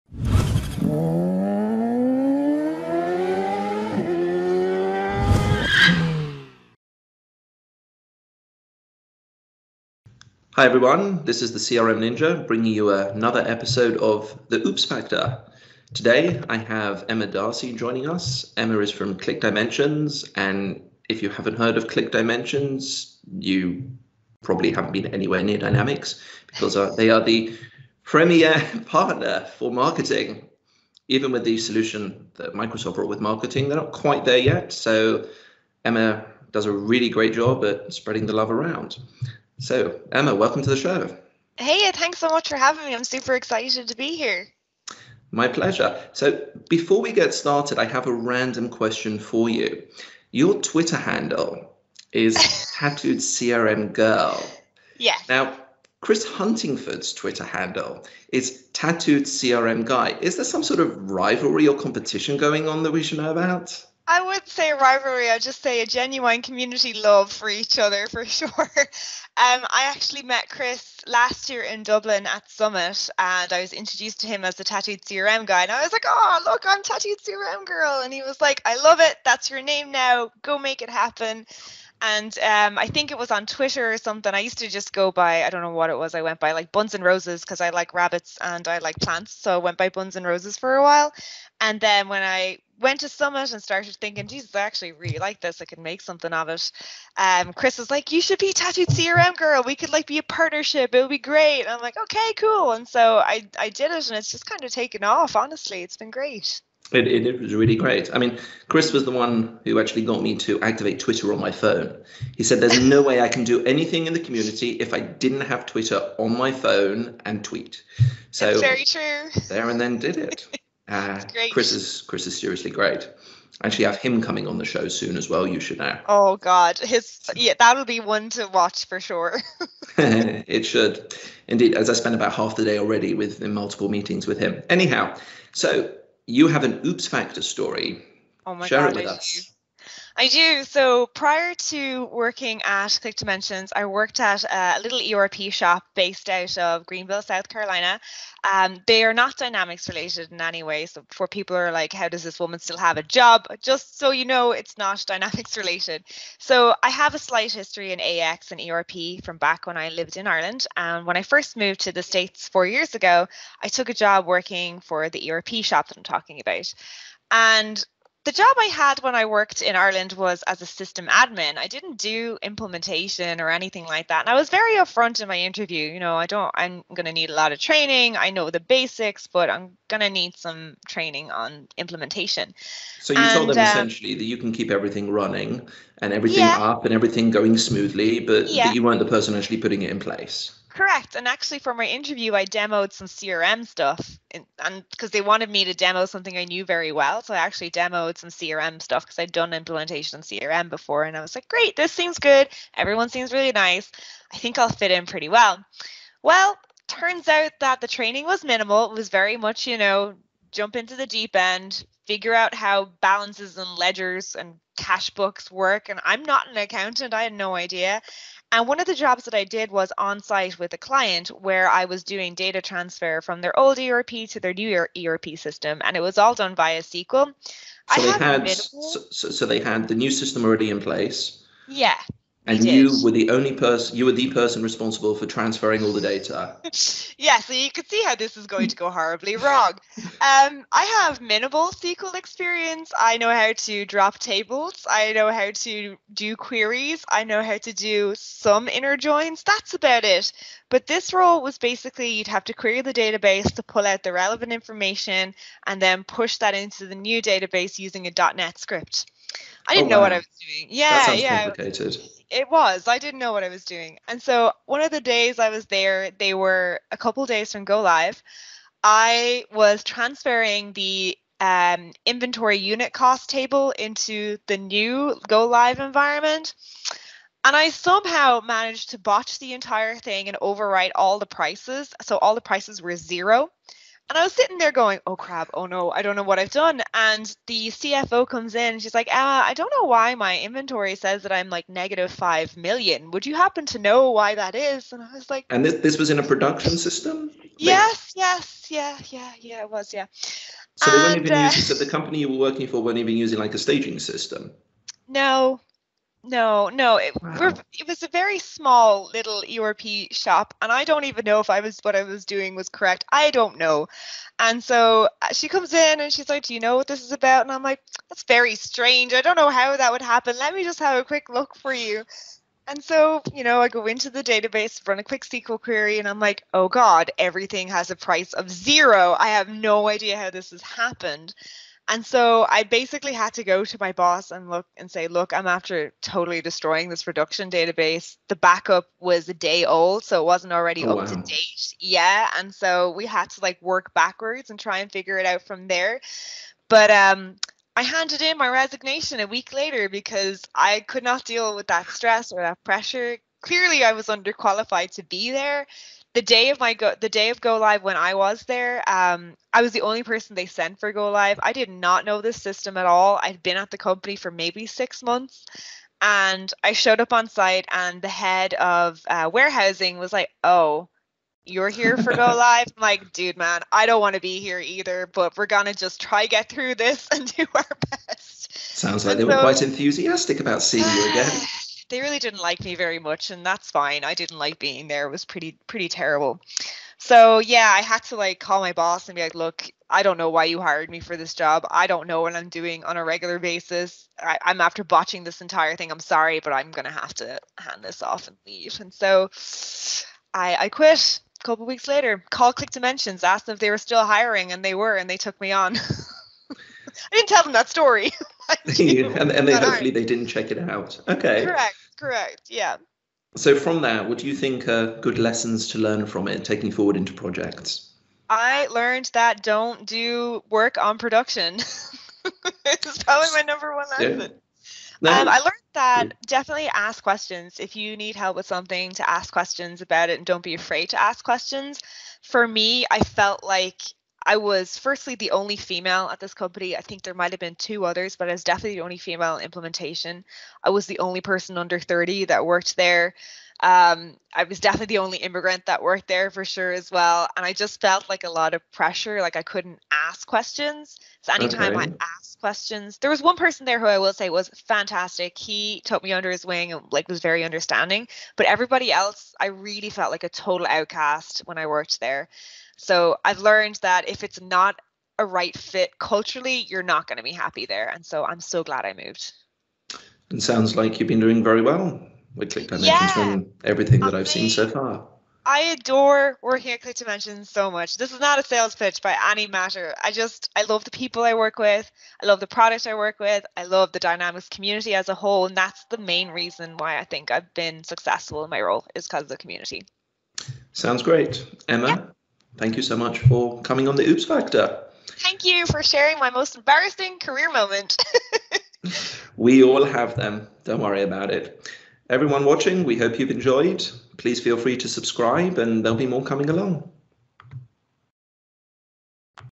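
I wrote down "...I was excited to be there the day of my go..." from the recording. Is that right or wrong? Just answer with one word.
wrong.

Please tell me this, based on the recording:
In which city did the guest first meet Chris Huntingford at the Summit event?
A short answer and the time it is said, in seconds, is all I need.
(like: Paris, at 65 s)
Dublin, at 71 s.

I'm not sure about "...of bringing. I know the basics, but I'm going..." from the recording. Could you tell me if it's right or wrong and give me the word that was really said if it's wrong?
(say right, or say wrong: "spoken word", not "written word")
wrong: "training", not "bringing".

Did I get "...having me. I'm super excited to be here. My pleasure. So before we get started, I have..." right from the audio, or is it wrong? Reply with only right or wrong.
right.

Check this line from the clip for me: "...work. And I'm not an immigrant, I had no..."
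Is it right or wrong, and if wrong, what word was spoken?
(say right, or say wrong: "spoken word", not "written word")
wrong: "accountant", not "immigrant".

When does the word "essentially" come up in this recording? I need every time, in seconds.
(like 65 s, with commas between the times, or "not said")
183 s.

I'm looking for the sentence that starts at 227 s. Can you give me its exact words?
So I they had, had so, so they had the new system already in place.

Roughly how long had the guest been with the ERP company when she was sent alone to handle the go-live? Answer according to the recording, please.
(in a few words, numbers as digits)
6 months.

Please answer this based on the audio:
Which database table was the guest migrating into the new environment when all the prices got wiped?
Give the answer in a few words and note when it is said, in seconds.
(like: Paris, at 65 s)
inventory unit cost, at 272 s.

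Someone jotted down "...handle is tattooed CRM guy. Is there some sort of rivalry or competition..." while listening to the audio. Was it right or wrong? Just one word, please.
right.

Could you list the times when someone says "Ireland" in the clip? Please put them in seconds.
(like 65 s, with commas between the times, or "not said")
160 s, 169 s.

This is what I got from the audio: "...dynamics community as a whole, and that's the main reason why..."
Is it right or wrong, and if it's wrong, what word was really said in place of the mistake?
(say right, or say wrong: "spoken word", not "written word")
right.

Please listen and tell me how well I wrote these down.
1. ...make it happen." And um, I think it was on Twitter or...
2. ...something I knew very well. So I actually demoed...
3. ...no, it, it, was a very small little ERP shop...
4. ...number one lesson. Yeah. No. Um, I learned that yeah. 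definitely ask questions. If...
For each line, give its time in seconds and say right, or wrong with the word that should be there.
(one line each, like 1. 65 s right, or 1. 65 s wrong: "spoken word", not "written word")
1. 80 s right
2. 196 s right
3. 306 s right
4. 423 s right.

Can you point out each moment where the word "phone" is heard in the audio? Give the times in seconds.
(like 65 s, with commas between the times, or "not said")
111 s, 116 s.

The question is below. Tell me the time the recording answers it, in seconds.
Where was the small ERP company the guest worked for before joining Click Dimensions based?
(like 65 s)
146 s.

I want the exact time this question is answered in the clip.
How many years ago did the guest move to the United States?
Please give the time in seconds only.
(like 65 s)
162 s.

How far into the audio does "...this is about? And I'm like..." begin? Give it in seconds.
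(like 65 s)
316 s.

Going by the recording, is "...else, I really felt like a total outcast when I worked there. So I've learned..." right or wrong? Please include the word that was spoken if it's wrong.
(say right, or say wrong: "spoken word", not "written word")
right.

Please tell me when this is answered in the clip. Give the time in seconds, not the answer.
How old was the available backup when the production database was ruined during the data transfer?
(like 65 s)
339 s.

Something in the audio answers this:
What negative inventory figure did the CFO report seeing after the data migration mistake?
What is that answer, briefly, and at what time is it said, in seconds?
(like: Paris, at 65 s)
5 million, at 291 s.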